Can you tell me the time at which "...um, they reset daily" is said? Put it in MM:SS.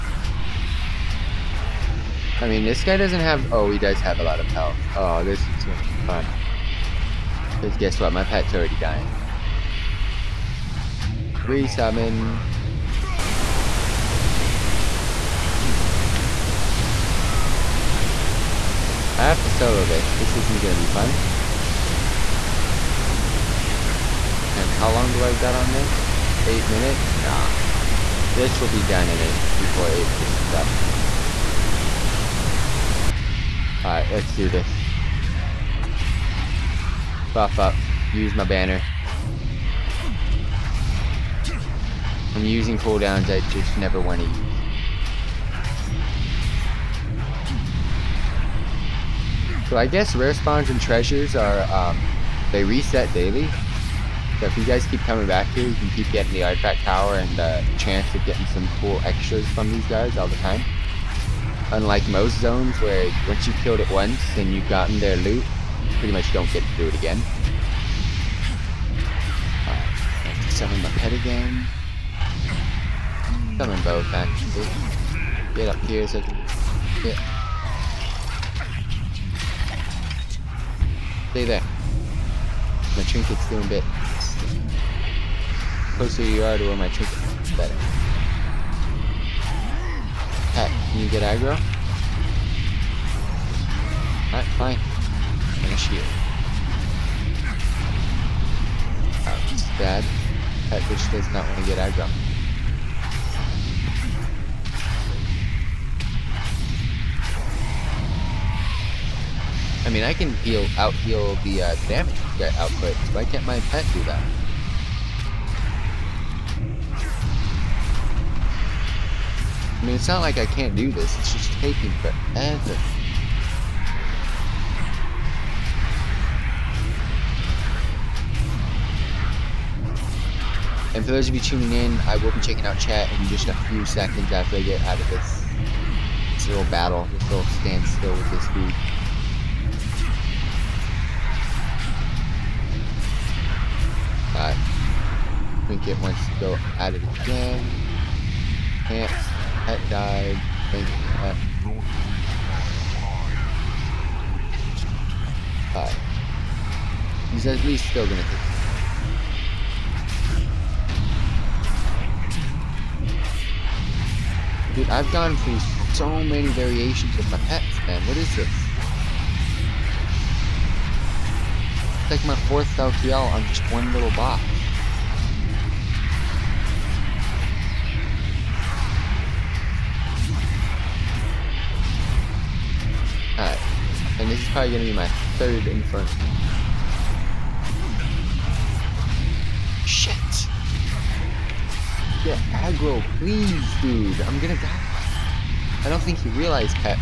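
00:51.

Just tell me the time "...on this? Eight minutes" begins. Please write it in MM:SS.
00:25.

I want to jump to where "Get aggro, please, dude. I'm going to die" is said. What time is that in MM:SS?
03:12.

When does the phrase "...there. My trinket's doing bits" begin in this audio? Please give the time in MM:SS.
01:21.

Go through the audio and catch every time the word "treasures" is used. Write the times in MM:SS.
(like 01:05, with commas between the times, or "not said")
00:50.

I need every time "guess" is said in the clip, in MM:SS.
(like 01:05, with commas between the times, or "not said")
00:07, 00:49.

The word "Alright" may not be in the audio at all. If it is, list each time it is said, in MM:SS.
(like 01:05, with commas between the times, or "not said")
01:34, 02:24.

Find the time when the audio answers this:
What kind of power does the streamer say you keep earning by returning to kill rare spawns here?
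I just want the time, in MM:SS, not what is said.
00:56.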